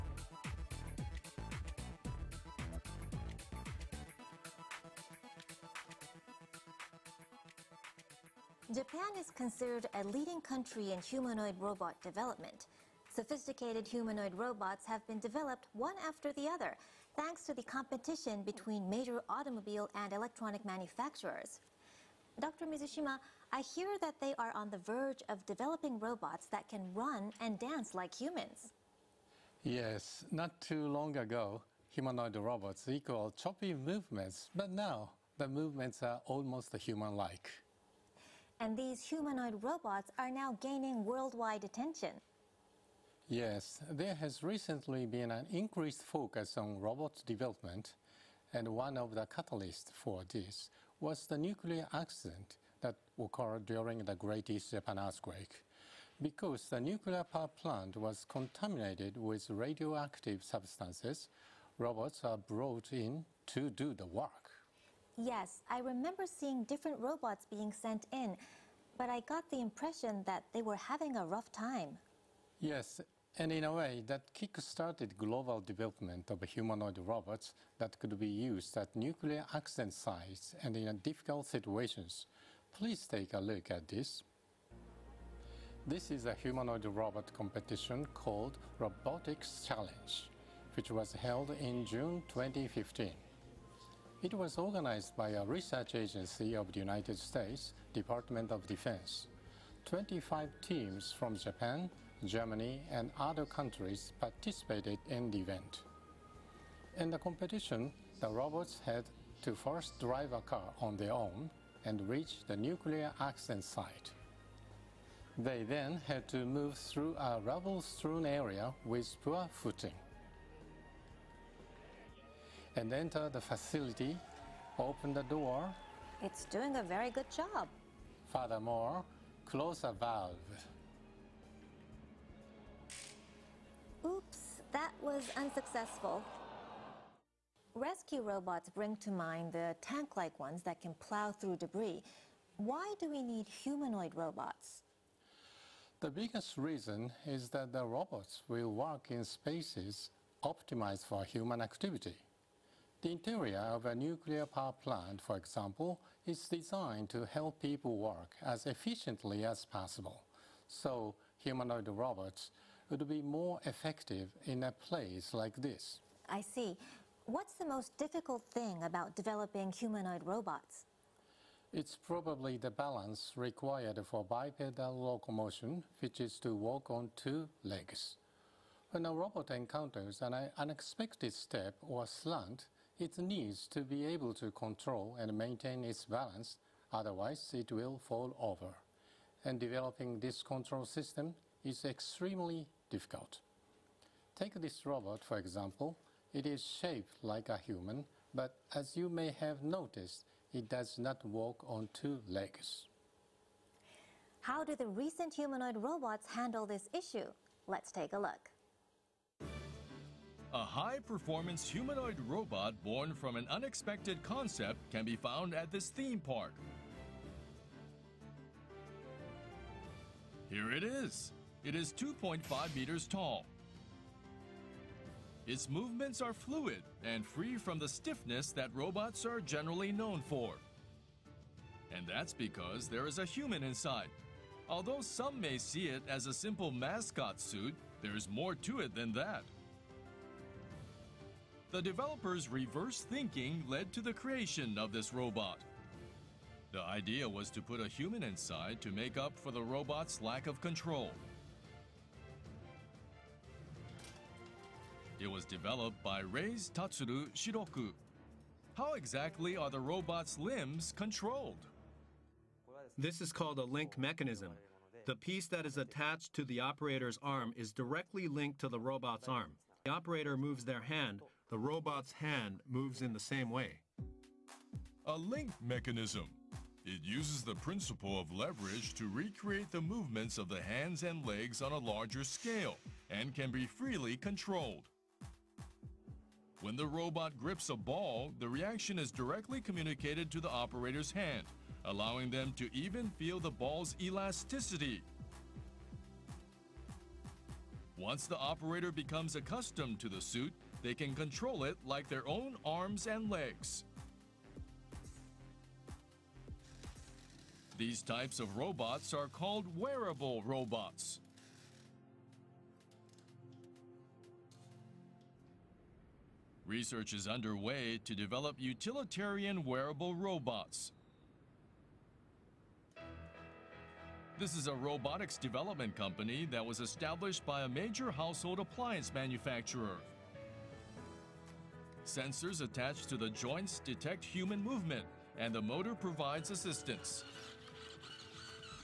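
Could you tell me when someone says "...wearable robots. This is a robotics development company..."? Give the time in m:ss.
5:19.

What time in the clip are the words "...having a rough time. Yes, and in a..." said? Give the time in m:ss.
1:10.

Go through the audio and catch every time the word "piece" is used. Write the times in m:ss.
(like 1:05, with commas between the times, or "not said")
4:25.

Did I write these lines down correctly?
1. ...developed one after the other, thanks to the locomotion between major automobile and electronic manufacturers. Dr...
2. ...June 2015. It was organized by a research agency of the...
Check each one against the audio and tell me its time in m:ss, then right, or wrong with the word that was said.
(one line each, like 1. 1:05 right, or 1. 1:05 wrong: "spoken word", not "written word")
1. 0:15 wrong: "competition", not "locomotion"
2. 1:31 right.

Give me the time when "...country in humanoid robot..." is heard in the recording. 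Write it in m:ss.
0:10.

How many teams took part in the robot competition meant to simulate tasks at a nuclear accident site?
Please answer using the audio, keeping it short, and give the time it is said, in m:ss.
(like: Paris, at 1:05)
25, at 1:39.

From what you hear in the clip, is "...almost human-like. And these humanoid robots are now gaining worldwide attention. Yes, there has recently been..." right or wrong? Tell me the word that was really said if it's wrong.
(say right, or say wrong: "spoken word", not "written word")
right.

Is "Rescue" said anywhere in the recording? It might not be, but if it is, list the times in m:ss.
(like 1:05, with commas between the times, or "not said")
2:17.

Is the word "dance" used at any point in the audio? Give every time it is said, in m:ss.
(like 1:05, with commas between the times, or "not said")
0:27.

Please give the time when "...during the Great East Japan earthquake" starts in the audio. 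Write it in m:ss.
0:53.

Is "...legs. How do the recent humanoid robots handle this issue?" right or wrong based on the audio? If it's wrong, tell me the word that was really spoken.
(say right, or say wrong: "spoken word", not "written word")
right.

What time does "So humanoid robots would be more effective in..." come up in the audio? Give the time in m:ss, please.
2:40.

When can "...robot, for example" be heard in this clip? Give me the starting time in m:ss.
3:14.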